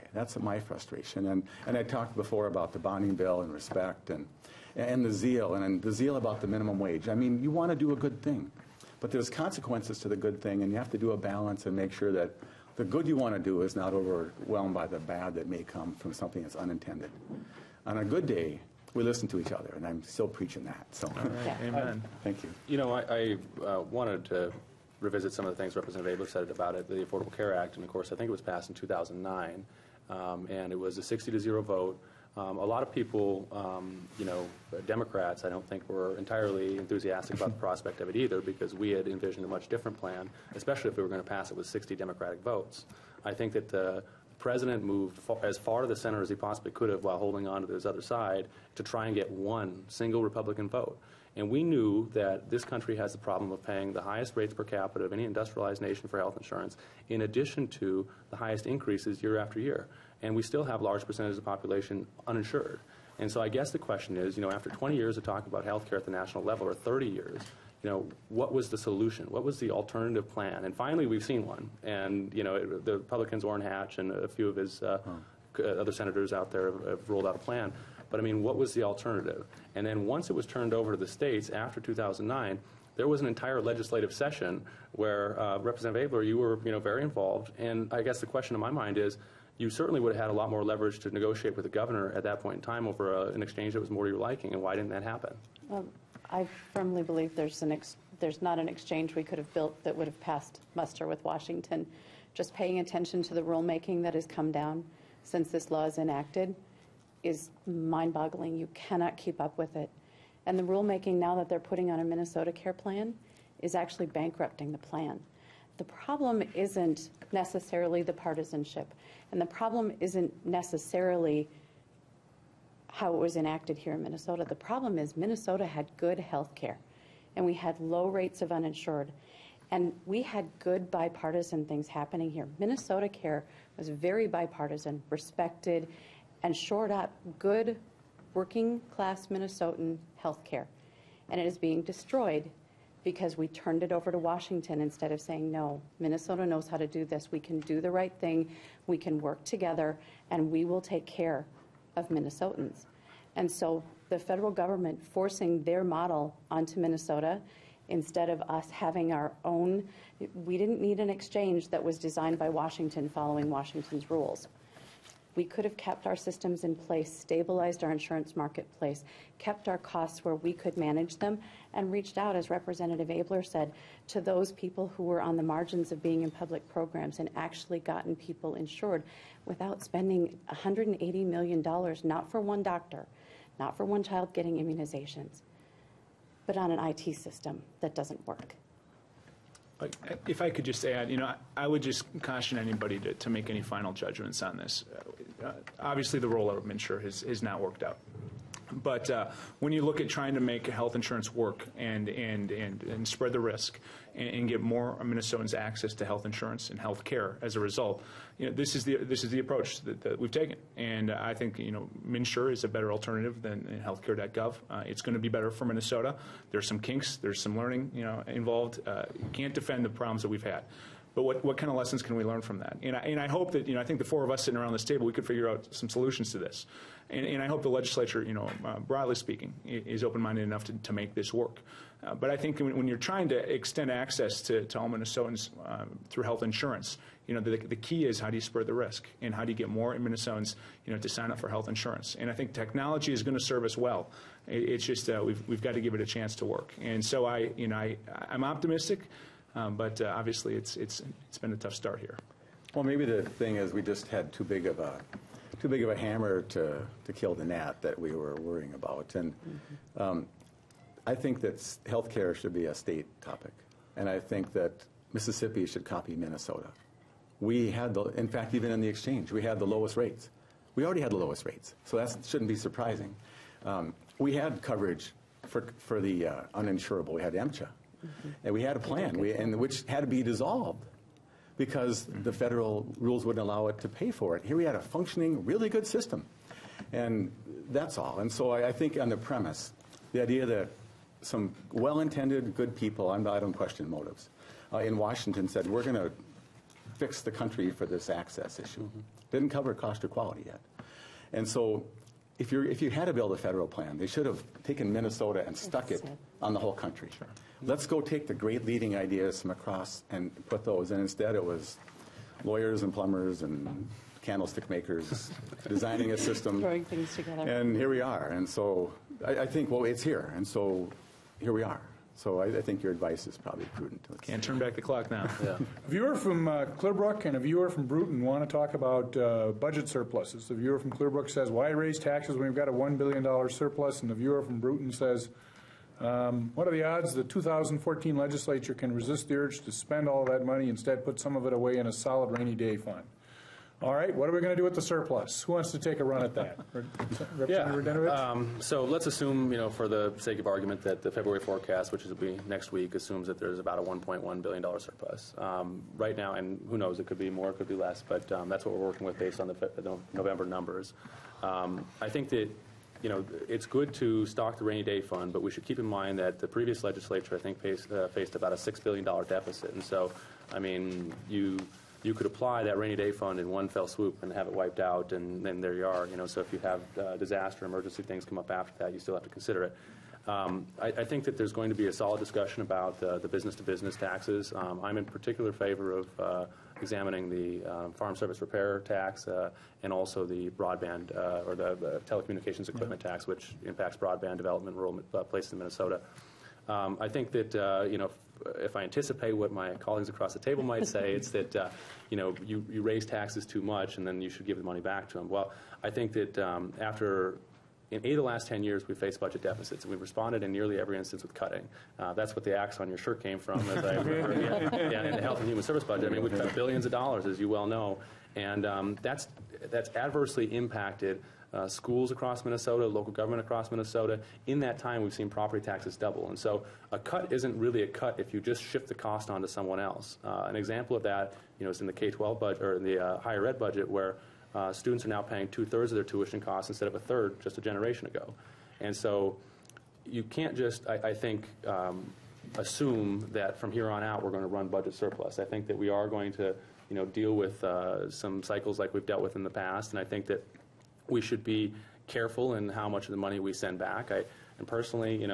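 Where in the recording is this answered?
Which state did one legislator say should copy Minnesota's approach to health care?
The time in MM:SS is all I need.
04:25.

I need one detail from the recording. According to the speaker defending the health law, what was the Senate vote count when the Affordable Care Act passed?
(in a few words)
60 to 0.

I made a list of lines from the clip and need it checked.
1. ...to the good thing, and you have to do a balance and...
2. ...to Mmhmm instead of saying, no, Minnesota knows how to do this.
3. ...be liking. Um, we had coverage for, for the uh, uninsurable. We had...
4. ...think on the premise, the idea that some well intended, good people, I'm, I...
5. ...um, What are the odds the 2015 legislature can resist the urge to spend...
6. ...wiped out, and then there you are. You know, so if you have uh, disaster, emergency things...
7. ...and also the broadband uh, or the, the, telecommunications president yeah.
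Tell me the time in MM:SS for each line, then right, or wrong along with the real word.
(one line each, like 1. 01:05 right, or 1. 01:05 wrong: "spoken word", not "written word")
1. 00:10 right
2. 02:24 wrong: "Washington", not "Mmhmm"
3. 04:32 wrong: "surprising", not "liking"
4. 04:48 right
5. 05:36 wrong: "2014", not "2015"
6. 06:14 right
7. 06:29 wrong: "equipment", not "president".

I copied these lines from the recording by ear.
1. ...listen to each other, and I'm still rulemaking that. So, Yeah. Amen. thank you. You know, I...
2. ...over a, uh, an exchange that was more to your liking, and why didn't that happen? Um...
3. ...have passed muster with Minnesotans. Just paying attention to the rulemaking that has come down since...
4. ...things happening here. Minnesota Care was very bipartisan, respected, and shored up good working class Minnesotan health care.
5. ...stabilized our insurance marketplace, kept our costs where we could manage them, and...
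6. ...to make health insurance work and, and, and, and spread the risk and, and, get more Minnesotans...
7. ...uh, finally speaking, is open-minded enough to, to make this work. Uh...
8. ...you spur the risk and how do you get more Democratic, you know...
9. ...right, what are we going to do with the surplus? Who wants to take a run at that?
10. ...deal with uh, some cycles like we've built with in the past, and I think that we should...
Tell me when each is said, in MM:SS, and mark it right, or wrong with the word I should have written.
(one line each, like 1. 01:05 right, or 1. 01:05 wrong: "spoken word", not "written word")
1. 00:19 wrong: "preaching", not "rulemaking"
2. 01:32 right
3. 01:40 wrong: "Washington", not "Minnesotans"
4. 02:11 right
5. 02:47 right
6. 03:20 right
7. 03:48 wrong: "broadly", not "finally"
8. 03:58 wrong: "Minnesotans", not "Democratic"
9. 05:43 right
10. 07:27 wrong: "dealt", not "built".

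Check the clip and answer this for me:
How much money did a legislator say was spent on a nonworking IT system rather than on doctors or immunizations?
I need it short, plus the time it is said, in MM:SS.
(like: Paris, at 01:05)
$180 million, at 03:00.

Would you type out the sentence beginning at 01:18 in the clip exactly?
But, I mean, what was the alternative?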